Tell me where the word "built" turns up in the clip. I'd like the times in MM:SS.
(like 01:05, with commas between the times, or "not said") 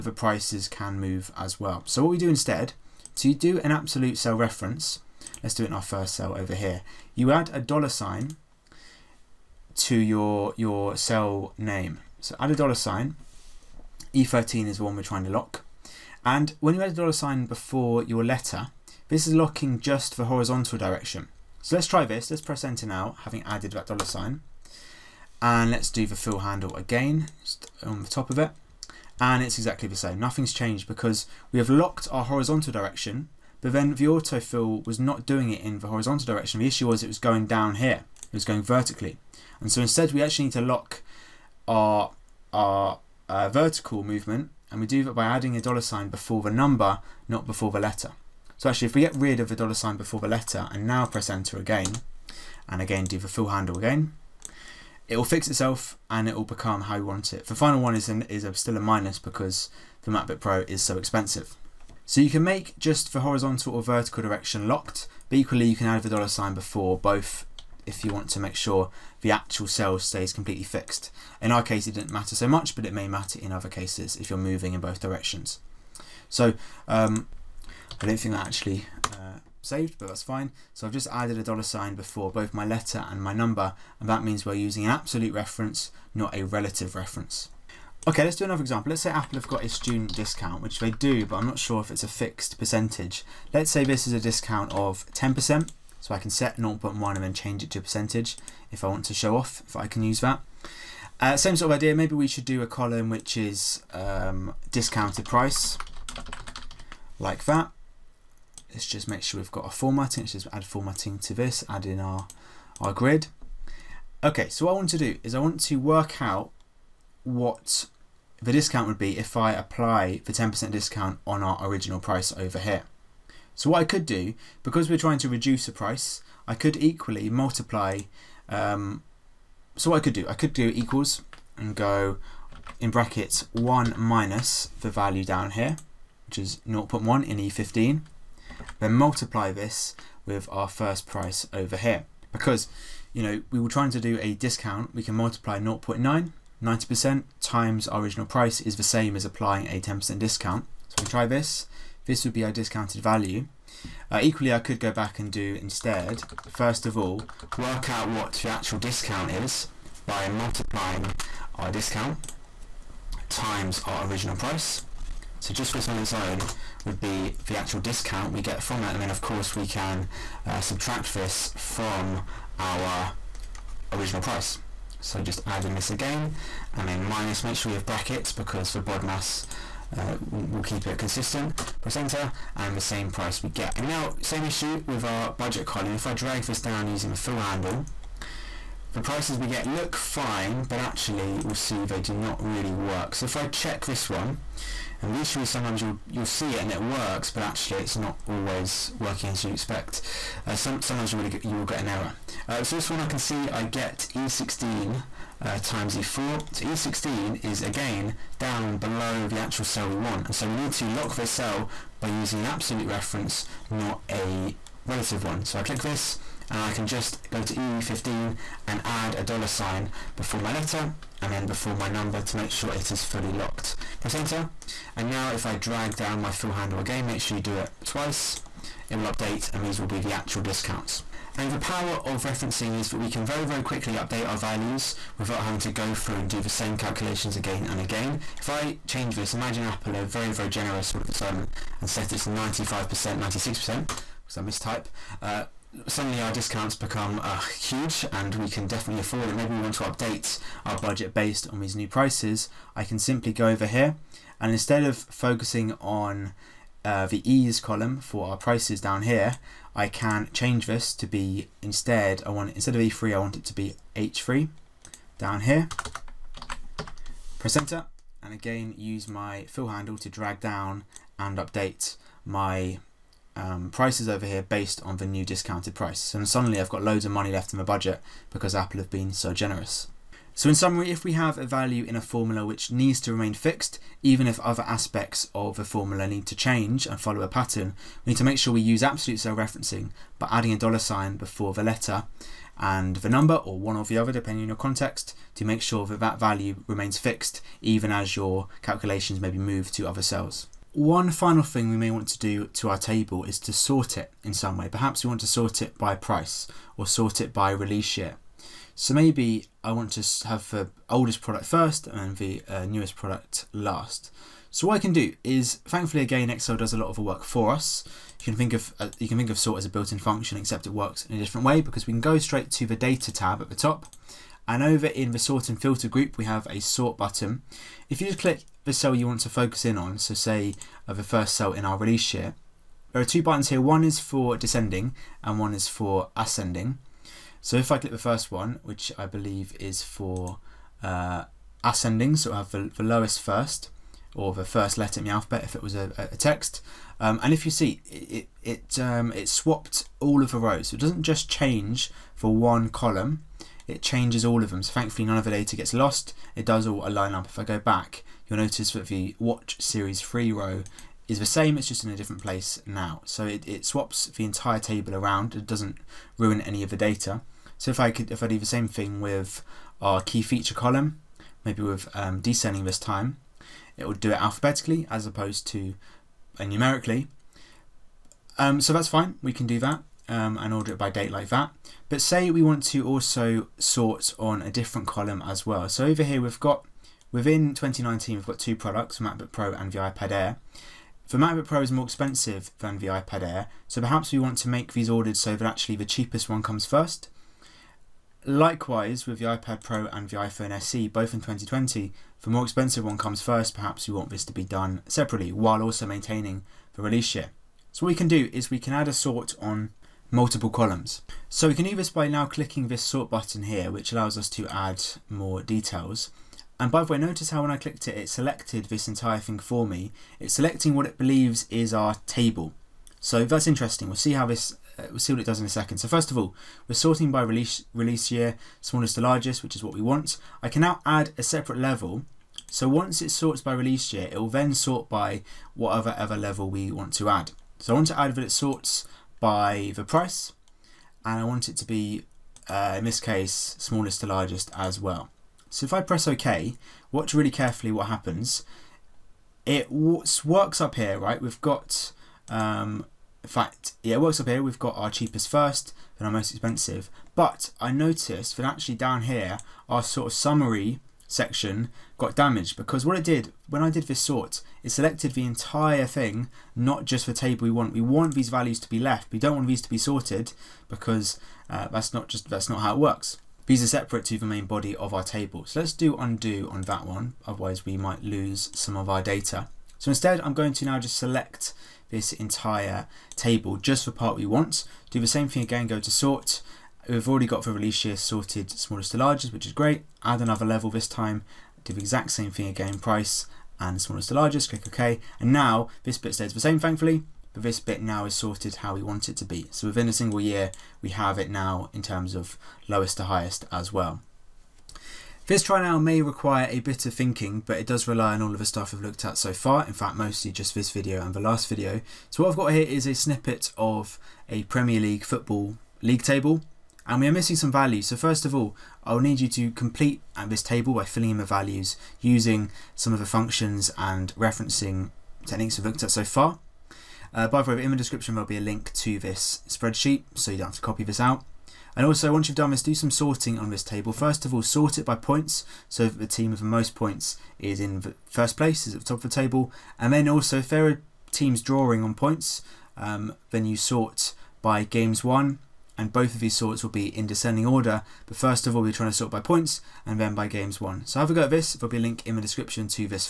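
05:19.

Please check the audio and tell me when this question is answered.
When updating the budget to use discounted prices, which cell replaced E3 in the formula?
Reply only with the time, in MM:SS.
04:23.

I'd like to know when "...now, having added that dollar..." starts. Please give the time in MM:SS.
00:22.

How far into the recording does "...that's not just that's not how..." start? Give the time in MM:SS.
07:51.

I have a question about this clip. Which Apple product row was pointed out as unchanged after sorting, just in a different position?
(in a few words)
Watch Series 3.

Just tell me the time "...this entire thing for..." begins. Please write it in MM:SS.
06:58.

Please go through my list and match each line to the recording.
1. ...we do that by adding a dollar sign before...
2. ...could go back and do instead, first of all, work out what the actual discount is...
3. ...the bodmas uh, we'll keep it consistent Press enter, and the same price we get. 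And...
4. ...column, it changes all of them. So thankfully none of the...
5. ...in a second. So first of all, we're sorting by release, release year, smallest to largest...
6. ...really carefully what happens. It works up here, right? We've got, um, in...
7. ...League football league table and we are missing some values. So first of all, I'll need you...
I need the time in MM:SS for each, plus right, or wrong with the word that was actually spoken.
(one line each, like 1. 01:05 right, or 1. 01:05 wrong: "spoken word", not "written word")
1. 00:44 right
2. 02:34 right
3. 02:58 right
4. 05:52 right
5. 07:05 right
6. 07:27 right
7. 08:34 right.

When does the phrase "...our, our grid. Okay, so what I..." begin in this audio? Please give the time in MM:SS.
01:51.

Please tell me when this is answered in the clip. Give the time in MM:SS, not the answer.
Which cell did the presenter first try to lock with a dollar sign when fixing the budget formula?
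00:14.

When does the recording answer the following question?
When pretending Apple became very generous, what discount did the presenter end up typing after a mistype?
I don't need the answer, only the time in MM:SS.
04:02.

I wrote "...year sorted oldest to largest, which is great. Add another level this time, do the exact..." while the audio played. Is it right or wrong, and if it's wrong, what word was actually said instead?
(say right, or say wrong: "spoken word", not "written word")
wrong: "smallest", not "oldest".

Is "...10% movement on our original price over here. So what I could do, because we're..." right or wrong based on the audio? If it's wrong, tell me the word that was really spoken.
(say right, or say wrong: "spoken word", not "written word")
wrong: "discount", not "movement".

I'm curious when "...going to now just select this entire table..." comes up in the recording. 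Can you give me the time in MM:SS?
08:00.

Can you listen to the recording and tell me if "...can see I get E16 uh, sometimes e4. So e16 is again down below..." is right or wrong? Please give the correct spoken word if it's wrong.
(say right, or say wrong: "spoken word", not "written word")
wrong: "times", not "sometimes".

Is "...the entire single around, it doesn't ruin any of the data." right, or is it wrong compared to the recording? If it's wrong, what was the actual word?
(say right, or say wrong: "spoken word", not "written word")
wrong: "table", not "single".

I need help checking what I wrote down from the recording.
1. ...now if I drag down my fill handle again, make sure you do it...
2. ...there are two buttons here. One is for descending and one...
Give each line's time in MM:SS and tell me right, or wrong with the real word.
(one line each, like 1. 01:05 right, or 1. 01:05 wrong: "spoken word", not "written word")
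1. 03:45 right
2. 05:32 right.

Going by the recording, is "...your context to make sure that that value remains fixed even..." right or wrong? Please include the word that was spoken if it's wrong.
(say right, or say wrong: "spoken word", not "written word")
right.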